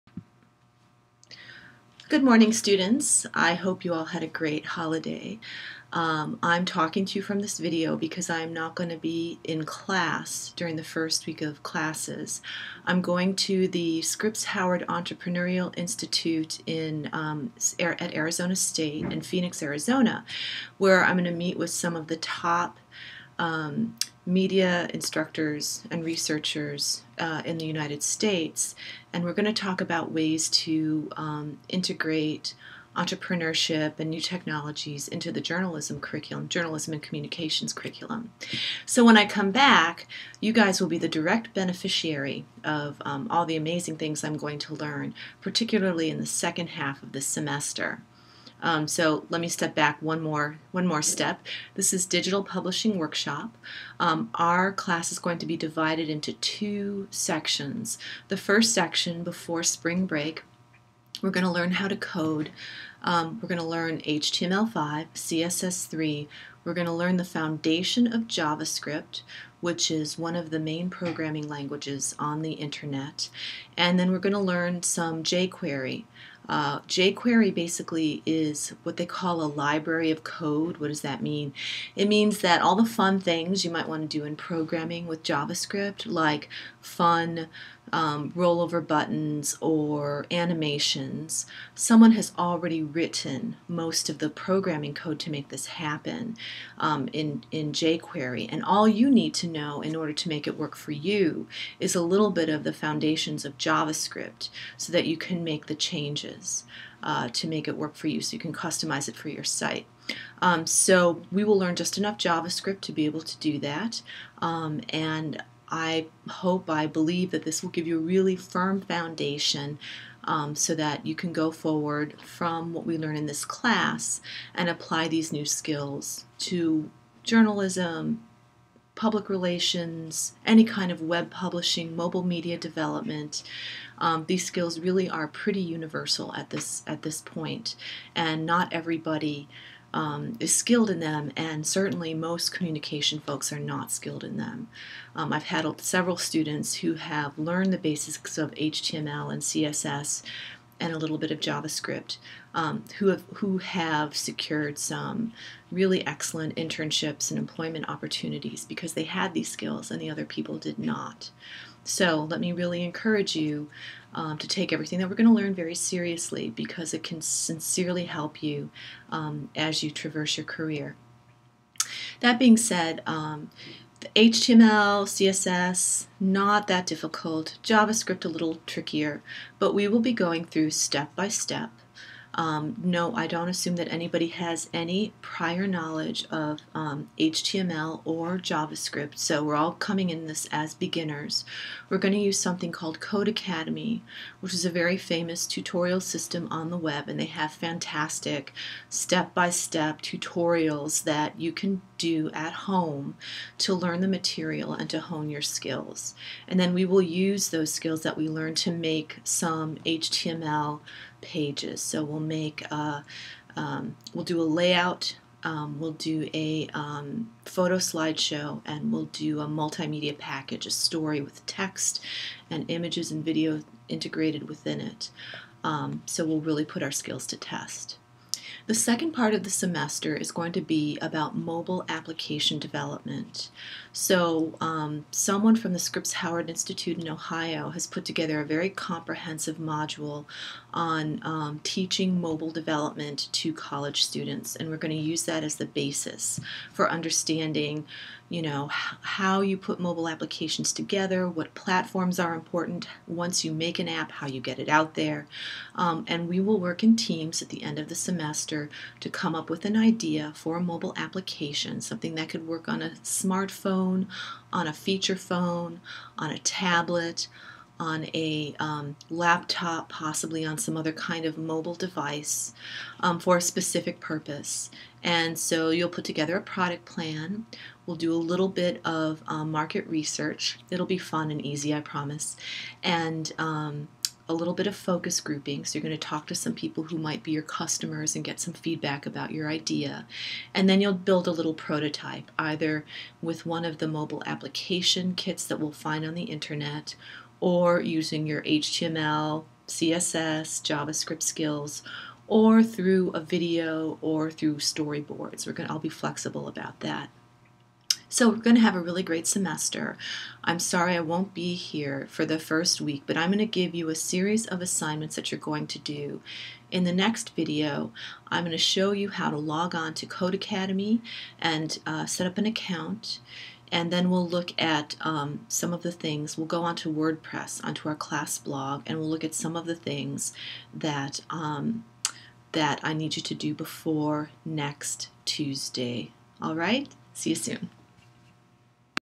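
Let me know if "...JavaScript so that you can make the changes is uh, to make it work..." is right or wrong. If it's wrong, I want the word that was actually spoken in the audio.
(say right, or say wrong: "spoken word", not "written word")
right.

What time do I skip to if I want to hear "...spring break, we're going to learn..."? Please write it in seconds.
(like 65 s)
59 s.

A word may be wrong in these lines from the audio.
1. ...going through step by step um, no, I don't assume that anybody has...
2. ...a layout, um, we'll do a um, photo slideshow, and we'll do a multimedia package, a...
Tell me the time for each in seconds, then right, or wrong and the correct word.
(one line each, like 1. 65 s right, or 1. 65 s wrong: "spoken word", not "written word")
1. 180 s right
2. 214 s right.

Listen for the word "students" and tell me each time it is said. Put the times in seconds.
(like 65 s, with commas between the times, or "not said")
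2 s, 146 s, 244 s.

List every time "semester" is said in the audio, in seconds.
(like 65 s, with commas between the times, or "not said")
47 s, 229 s, 257 s, 309 s.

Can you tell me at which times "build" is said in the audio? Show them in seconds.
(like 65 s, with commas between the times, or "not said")
290 s.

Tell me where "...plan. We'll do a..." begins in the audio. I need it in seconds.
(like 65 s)
276 s.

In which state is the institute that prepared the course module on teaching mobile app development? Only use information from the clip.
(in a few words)
Ohio.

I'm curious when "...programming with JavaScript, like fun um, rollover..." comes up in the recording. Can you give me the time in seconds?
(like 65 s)
84 s.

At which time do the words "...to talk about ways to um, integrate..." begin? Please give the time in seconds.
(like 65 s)
29 s.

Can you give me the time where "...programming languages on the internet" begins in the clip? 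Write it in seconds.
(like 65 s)
70 s.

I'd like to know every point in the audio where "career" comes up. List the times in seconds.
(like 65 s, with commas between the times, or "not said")
170 s.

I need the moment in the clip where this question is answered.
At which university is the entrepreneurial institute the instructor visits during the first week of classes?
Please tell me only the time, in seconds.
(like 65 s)
18 s.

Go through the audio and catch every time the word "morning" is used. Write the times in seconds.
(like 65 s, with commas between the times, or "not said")
2 s.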